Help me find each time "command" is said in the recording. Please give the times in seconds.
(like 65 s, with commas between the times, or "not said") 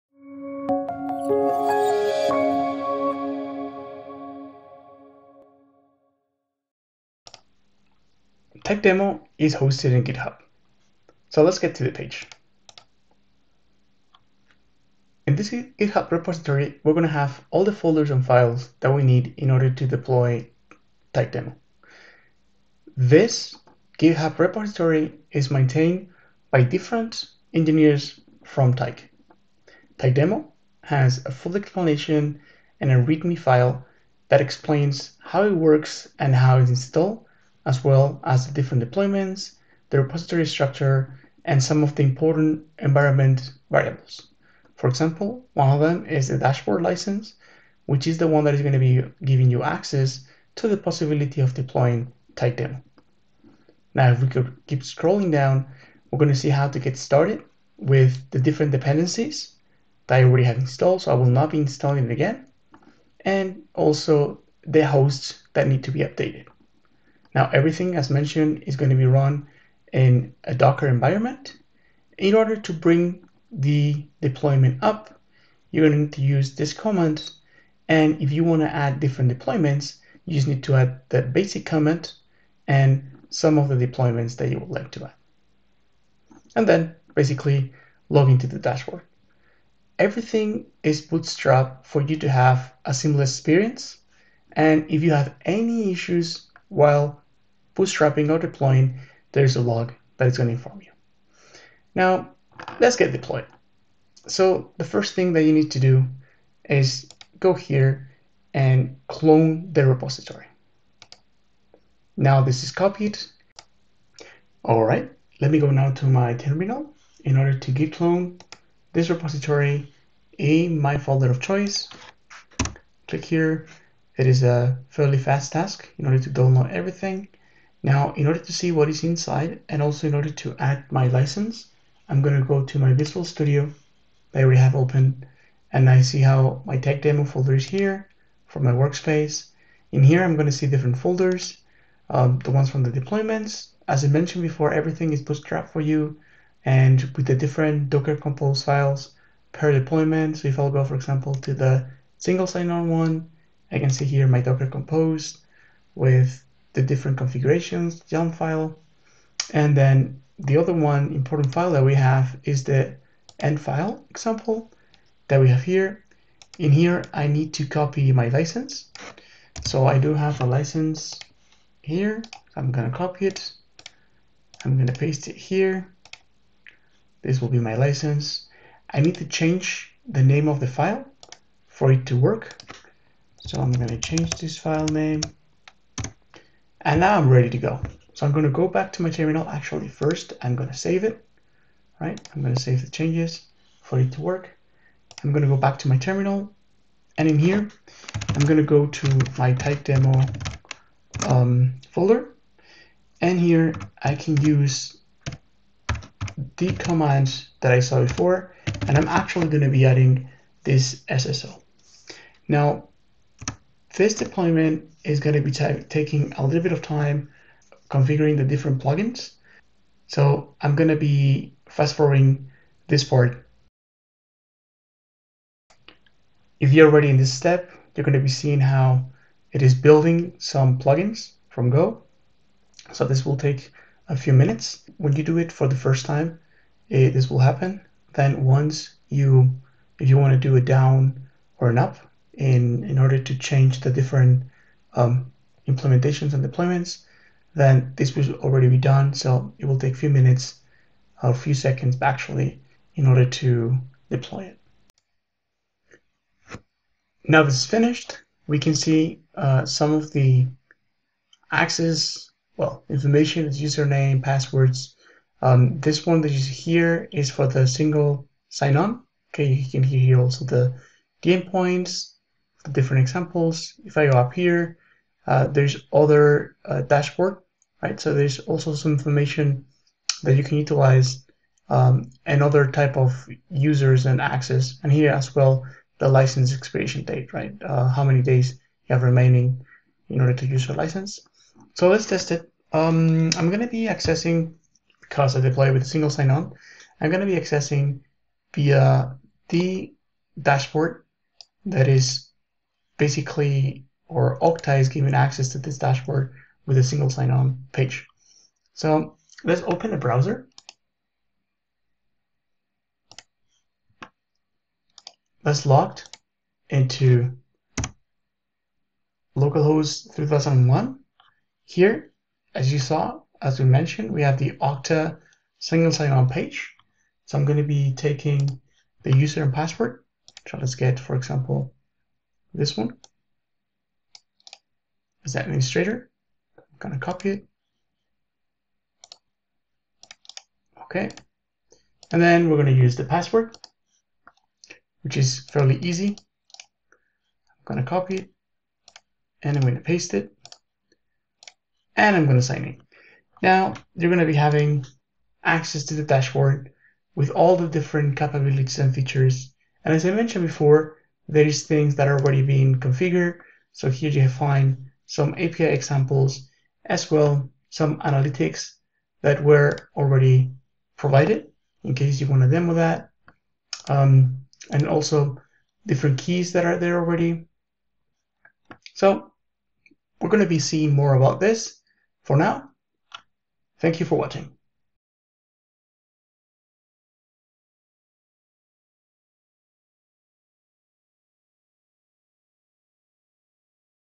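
76 s, 81 s, 206 s.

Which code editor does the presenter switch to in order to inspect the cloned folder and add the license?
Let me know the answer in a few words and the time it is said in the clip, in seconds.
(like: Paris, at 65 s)
Visual Studio, at 132 s.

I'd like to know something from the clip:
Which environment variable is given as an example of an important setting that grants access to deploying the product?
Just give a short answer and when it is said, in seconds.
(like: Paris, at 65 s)
dashboard license, at 46 s.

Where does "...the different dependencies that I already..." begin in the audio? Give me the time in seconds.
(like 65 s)
58 s.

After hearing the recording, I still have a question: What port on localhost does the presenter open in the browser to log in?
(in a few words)
3001.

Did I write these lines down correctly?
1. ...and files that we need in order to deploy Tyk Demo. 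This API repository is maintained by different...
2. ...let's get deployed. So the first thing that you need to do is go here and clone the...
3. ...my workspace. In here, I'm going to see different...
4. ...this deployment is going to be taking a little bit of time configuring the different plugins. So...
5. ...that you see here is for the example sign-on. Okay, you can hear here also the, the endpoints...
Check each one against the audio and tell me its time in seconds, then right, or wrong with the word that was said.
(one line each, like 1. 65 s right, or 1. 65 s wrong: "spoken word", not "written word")
1. 18 s wrong: "GitHub", not "API"
2. 102 s right
3. 138 s right
4. 213 s right
5. 266 s wrong: "single", not "example".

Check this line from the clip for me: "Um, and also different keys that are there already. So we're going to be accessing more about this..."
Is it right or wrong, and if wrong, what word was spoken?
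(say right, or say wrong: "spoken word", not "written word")
wrong: "seeing", not "accessing".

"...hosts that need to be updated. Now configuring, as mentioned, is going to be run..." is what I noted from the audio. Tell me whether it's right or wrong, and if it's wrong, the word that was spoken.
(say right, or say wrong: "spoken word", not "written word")
wrong: "everything", not "configuring".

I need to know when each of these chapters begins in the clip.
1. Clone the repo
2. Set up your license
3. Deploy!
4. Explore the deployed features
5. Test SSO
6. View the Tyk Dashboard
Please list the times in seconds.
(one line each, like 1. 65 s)
1. 101 s
2. 162 s
3. 195 s
4. 258 s
5. 298 s
6. 355 s.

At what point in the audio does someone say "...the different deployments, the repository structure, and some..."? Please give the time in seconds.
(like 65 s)
38 s.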